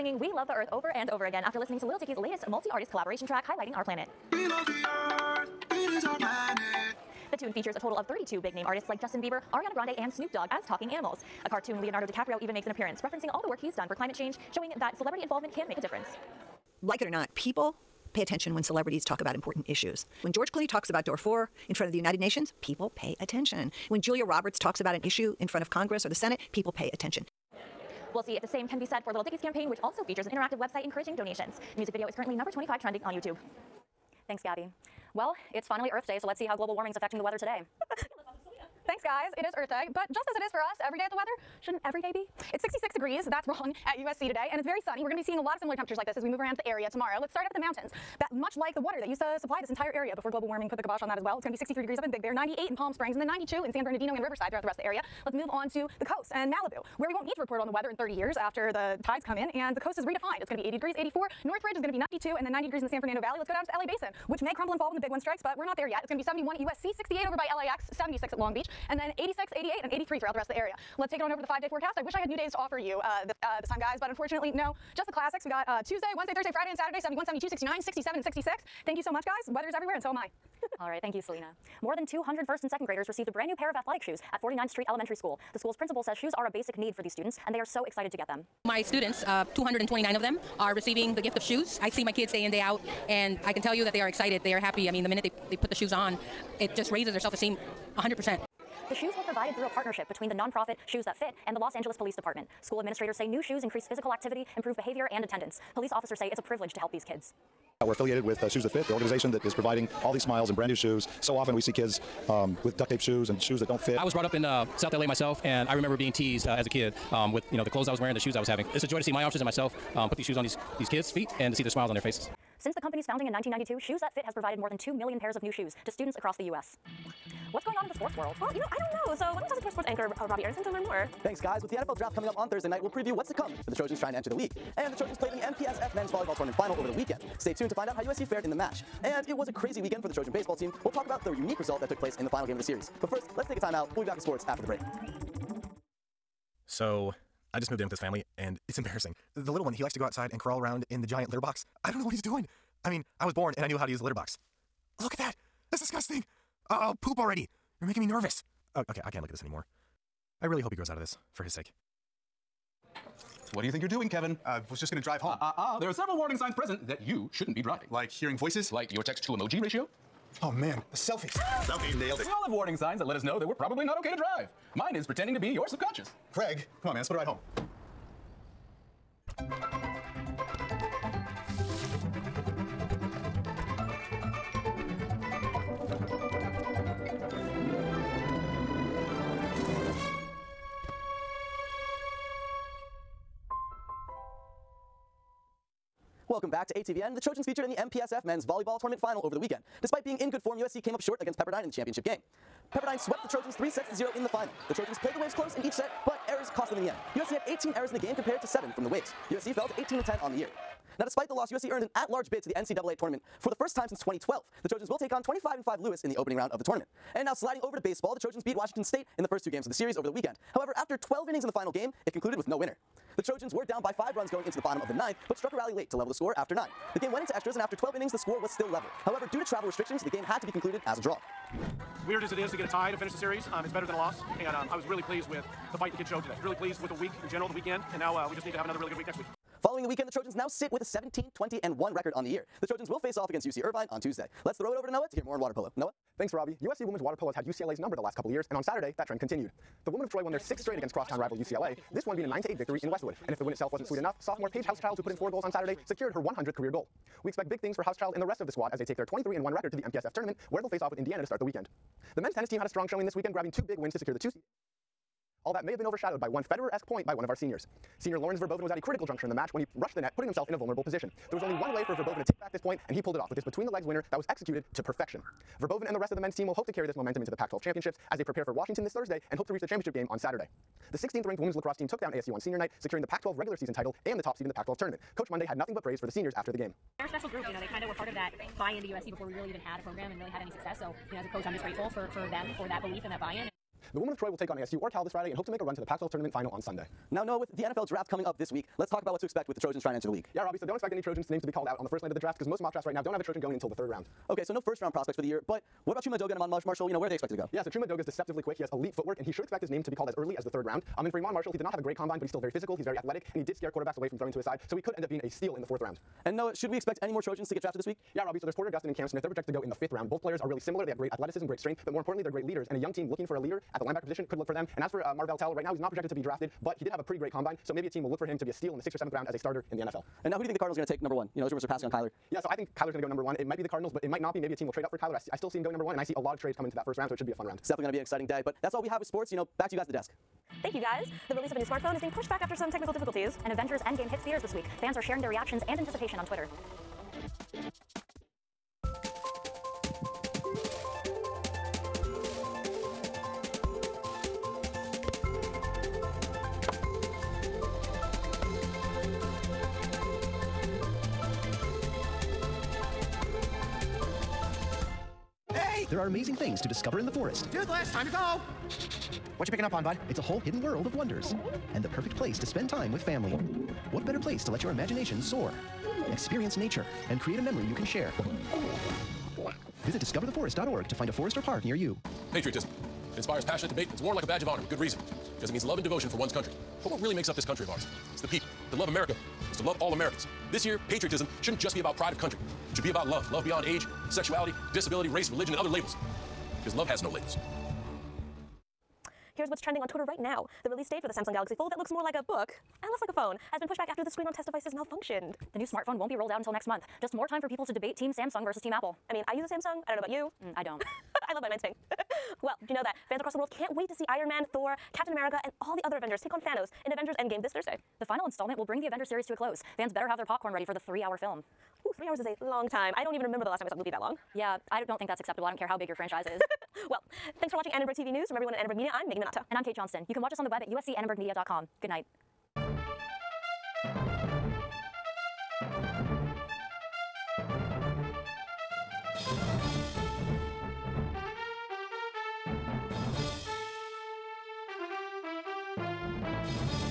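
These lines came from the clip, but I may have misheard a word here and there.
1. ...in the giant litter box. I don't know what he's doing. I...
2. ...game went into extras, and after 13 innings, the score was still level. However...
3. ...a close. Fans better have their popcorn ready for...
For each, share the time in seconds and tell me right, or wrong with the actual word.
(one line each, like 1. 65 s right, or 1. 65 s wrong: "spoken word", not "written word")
1. 150 s right
2. 226 s wrong: "12", not "13"
3. 419 s right.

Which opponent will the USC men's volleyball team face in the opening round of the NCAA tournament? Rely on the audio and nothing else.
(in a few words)
Lewis.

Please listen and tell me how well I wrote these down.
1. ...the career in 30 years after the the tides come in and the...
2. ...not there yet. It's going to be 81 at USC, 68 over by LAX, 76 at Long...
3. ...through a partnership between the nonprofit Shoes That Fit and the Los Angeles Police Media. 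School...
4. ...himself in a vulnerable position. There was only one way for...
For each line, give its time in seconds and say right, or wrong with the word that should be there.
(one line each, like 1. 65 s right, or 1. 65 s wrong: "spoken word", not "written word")
1. 57 s wrong: "weather", not "career"
2. 65 s wrong: "71", not "81"
3. 99 s wrong: "Department", not "Media"
4. 270 s right.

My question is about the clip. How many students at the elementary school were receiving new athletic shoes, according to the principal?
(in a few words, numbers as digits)
229.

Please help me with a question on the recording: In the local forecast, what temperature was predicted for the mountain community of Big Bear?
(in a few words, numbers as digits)
63 degrees.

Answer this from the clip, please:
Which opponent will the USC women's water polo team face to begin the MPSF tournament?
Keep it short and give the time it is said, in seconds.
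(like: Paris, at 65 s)
Indiana, at 260 s.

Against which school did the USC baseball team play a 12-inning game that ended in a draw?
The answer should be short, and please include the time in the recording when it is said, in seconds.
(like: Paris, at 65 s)
Washington State, at 218 s.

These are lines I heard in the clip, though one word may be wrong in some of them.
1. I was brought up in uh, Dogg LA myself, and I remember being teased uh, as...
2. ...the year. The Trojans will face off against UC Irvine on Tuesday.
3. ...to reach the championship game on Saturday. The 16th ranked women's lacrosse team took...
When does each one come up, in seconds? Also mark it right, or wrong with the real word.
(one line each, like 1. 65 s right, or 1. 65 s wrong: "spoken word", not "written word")
1. 113 s wrong: "South", not "Dogg"
2. 242 s right
3. 279 s right.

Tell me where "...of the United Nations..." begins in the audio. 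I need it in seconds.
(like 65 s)
21 s.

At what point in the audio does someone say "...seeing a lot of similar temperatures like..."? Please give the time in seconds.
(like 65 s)
45 s.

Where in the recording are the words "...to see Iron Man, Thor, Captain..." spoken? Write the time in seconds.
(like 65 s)
413 s.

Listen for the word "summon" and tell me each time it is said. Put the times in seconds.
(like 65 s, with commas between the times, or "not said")
not said.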